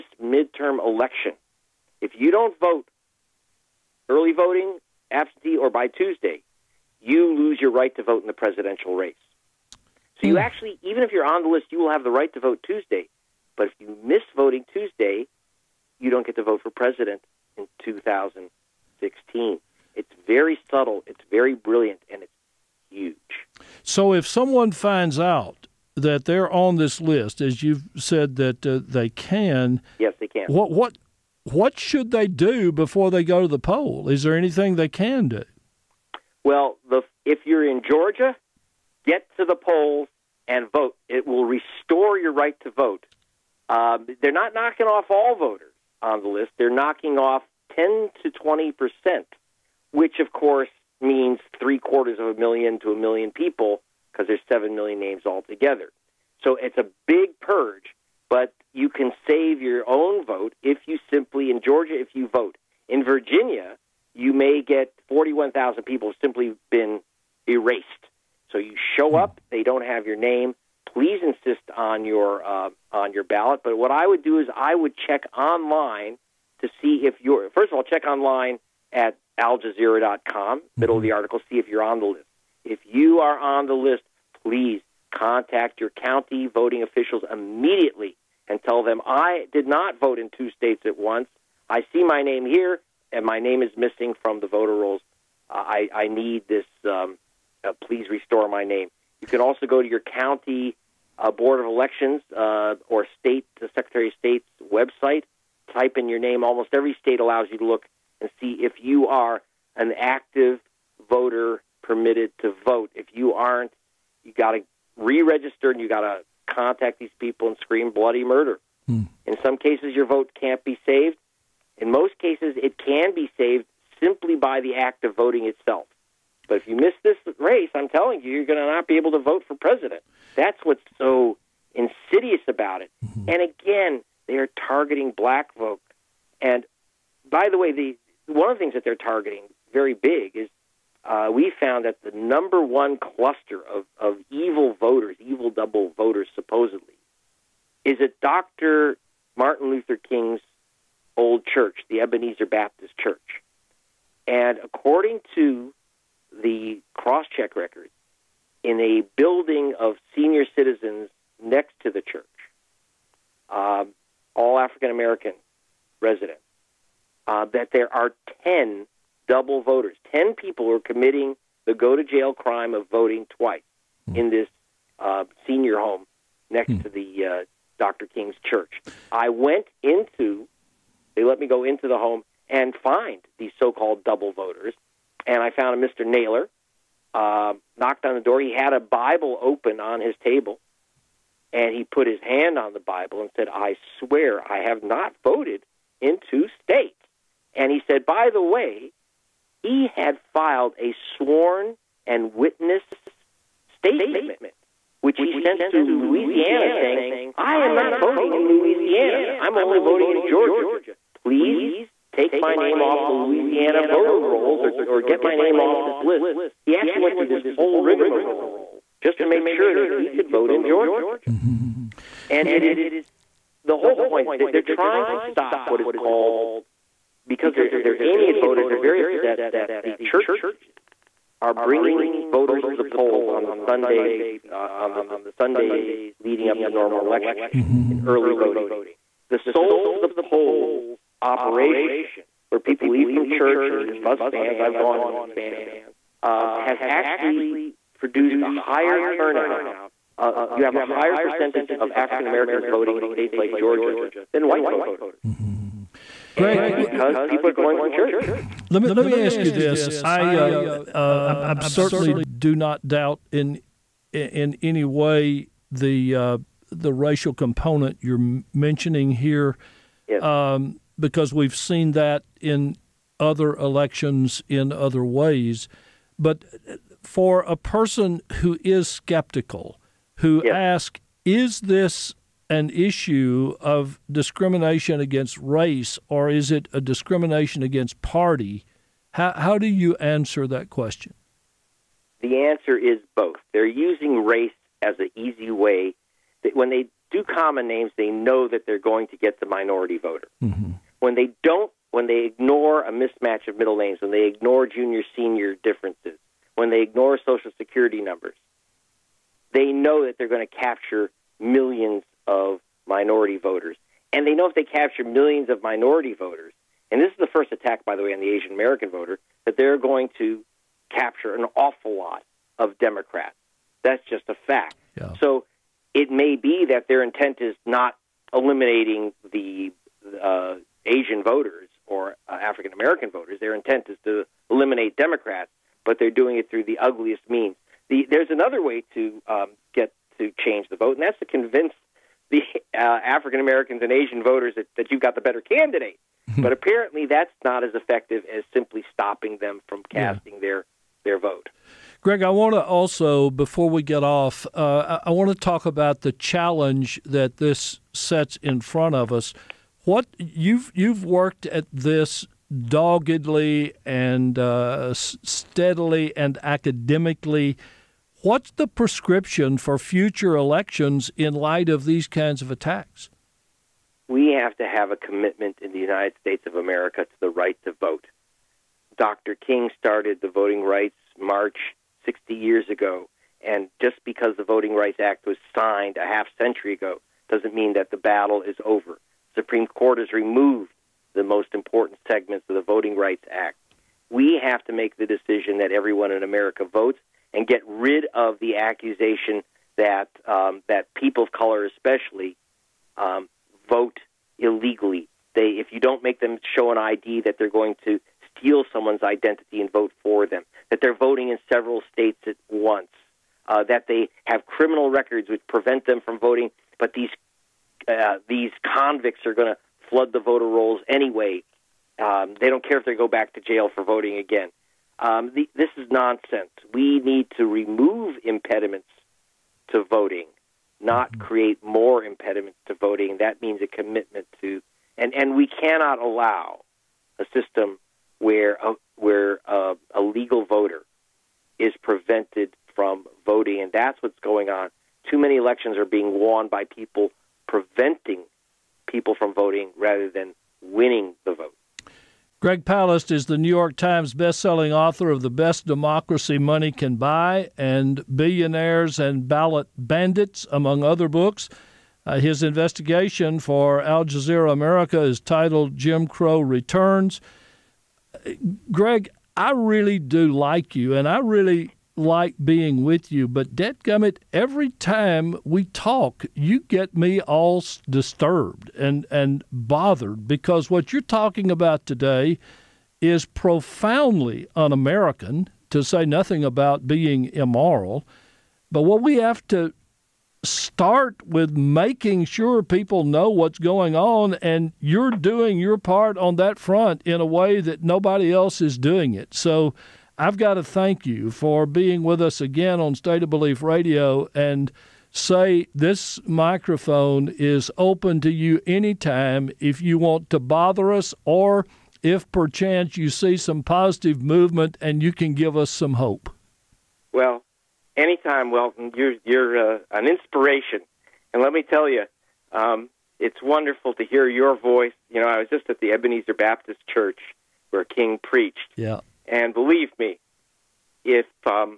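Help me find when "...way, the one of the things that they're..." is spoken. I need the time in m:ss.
2:17.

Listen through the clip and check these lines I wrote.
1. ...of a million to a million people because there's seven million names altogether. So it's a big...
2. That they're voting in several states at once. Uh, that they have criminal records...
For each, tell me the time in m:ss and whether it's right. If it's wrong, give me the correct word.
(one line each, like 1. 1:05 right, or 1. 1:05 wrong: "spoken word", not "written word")
1. 0:52 right
2. 6:50 right.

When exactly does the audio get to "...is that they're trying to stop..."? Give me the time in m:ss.
3:44.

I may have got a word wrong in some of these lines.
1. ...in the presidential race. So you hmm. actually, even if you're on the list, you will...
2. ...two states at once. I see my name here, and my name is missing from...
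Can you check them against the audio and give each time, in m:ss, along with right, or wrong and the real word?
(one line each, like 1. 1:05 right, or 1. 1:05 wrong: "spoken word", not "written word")
1. 0:08 right
2. 1:30 right.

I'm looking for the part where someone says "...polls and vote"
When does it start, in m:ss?
0:39.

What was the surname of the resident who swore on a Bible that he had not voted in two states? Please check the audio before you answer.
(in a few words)
Naylor.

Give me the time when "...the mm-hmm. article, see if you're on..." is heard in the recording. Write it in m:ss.
1:21.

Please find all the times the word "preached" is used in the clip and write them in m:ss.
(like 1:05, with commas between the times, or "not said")
8:48.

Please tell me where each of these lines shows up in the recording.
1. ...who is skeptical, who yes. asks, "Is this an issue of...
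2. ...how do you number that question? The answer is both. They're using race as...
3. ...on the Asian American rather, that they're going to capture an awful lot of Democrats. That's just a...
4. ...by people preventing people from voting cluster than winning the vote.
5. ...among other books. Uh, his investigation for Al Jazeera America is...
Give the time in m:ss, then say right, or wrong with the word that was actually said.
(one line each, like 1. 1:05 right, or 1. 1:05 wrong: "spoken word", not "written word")
1. 4:38 right
2. 4:49 wrong: "answer", not "number"
3. 5:18 wrong: "voter", not "rather"
4. 7:26 wrong: "rather", not "cluster"
5. 7:40 right.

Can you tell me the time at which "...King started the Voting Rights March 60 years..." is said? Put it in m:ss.
6:19.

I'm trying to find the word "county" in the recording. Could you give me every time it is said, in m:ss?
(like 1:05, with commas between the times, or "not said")
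1:25, 1:39.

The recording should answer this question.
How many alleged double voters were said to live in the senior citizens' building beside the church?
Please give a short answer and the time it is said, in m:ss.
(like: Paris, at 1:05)
10, at 2:48.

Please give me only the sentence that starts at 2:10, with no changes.
That's what's so insidious about it.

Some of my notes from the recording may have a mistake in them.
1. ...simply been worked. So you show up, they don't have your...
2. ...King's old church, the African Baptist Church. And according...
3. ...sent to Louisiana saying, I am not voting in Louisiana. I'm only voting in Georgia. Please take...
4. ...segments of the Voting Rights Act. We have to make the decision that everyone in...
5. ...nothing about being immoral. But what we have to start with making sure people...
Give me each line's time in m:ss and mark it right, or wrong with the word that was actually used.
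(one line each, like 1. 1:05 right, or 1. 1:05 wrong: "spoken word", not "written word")
1. 1:06 wrong: "erased", not "worked"
2. 2:29 wrong: "Ebenezer", not "African"
3. 3:25 right
4. 6:32 right
5. 8:06 right.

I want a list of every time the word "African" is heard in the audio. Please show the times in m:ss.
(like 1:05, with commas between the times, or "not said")
2:44, 4:11, 5:32, 5:42.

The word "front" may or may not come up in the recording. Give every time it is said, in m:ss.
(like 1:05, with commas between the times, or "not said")
5:58, 8:16.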